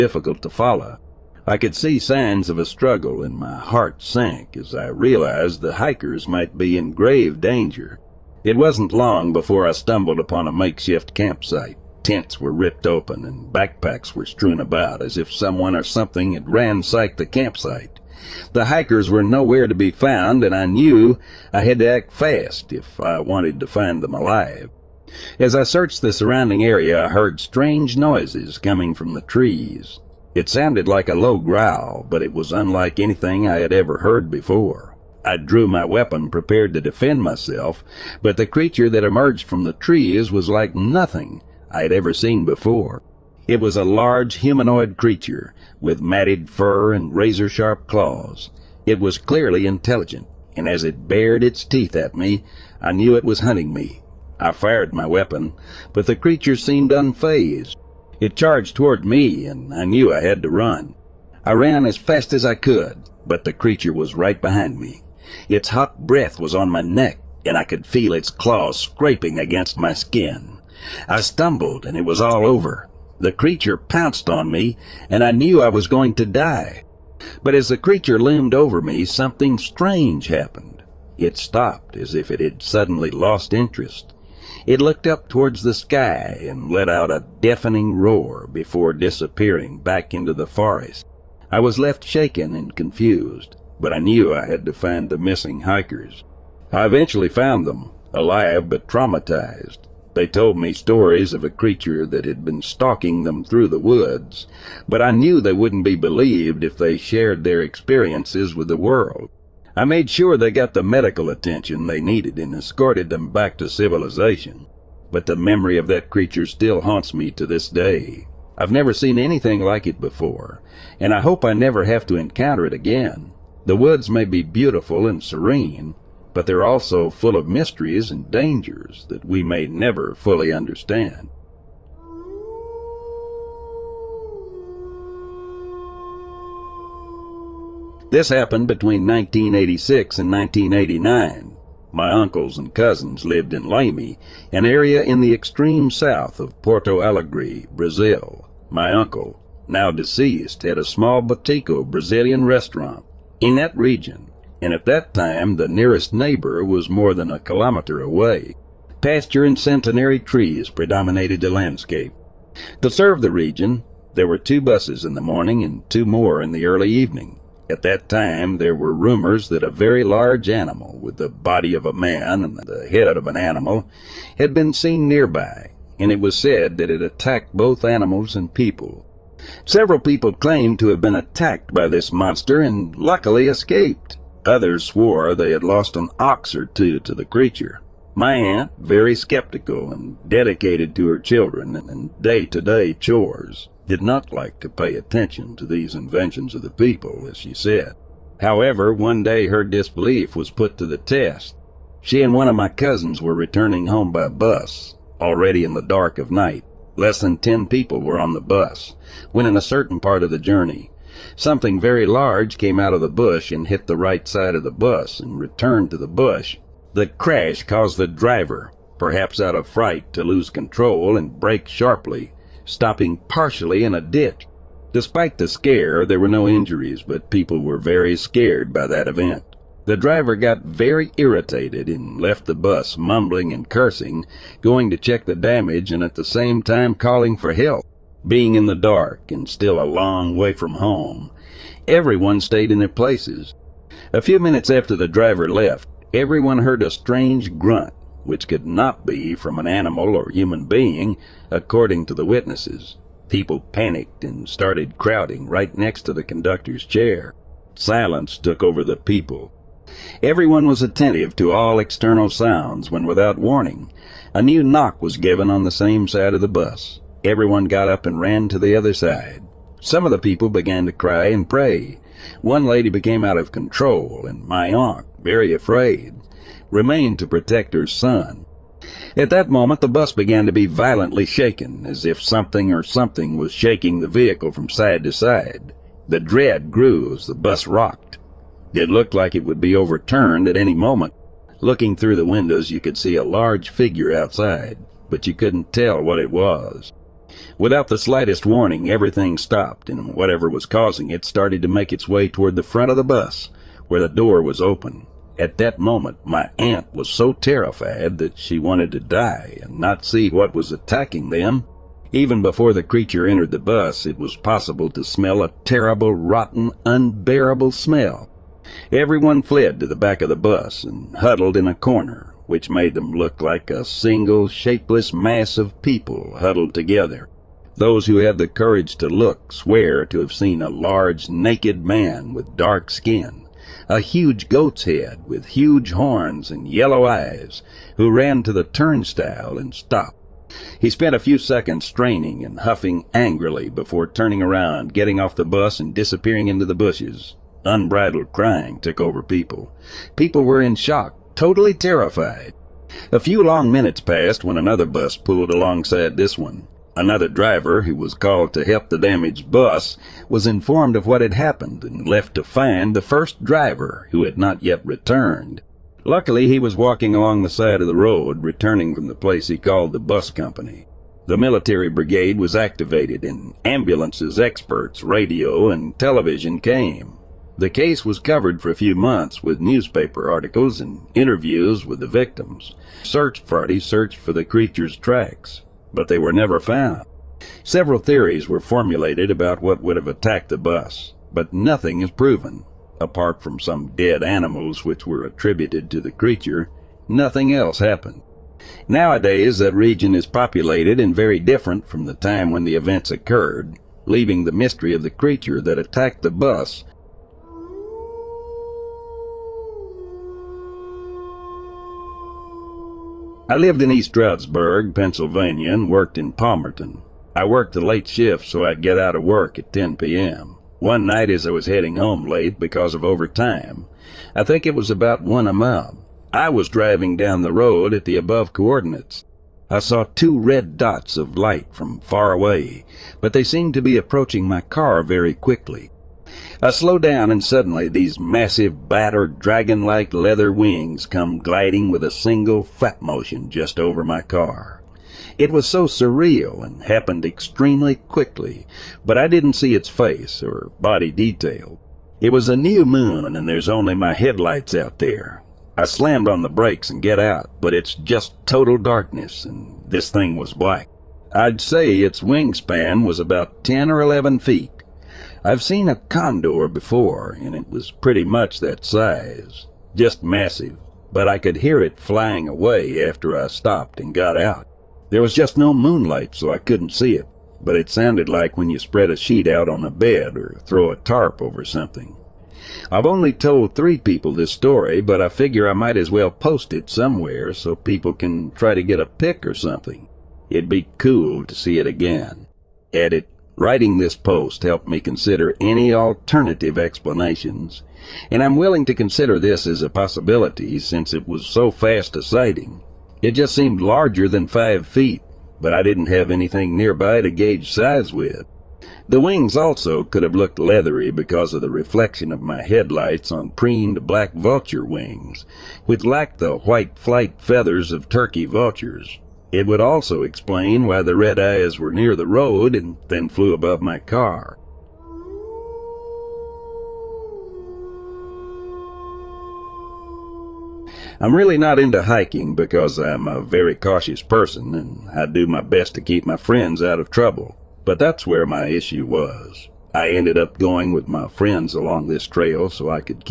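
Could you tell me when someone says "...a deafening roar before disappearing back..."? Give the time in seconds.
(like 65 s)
87 s.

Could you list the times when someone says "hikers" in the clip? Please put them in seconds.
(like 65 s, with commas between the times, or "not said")
5 s, 18 s, 95 s.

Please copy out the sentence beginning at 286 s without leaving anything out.
The dread grew as the bus rocked.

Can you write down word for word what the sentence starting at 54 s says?
I fired my weapon, but the creature seemed unfazed.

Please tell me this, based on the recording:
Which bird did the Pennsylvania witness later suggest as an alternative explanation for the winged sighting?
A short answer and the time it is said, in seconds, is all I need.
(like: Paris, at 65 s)
black vulture, at 514 s.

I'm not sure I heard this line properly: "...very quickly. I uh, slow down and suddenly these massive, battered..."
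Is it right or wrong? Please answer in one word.
right.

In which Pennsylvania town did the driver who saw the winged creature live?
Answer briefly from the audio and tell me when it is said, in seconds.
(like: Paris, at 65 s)
East Stroudsburg, at 413 s.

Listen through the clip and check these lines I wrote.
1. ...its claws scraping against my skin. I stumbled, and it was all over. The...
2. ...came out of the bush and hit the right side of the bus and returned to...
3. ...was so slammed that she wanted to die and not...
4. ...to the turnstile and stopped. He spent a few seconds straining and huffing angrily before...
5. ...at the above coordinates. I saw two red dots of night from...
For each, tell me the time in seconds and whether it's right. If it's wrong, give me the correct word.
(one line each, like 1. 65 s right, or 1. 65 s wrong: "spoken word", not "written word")
1. 68 s right
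2. 212 s right
3. 306 s wrong: "terrified", not "slammed"
4. 338 s right
5. 427 s wrong: "light", not "night".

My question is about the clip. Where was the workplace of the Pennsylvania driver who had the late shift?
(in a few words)
Palmerton.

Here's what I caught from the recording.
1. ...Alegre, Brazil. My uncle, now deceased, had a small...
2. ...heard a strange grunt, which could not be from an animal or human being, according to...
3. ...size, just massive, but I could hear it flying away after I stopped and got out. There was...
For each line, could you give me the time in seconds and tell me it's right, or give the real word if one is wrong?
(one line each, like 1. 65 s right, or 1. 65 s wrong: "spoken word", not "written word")
1. 147 s right
2. 246 s right
3. 468 s right.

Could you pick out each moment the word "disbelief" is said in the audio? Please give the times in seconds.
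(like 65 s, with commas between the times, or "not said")
199 s.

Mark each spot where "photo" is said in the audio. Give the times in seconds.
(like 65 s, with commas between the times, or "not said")
not said.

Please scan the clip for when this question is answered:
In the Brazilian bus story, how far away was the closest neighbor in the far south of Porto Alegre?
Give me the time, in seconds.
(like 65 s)
156 s.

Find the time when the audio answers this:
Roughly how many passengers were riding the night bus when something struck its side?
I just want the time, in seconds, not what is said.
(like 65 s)
206 s.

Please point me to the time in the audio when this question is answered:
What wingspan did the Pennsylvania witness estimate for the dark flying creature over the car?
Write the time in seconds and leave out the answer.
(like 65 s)
463 s.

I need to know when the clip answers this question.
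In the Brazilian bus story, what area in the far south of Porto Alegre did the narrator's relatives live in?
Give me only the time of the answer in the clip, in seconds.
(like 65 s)
143 s.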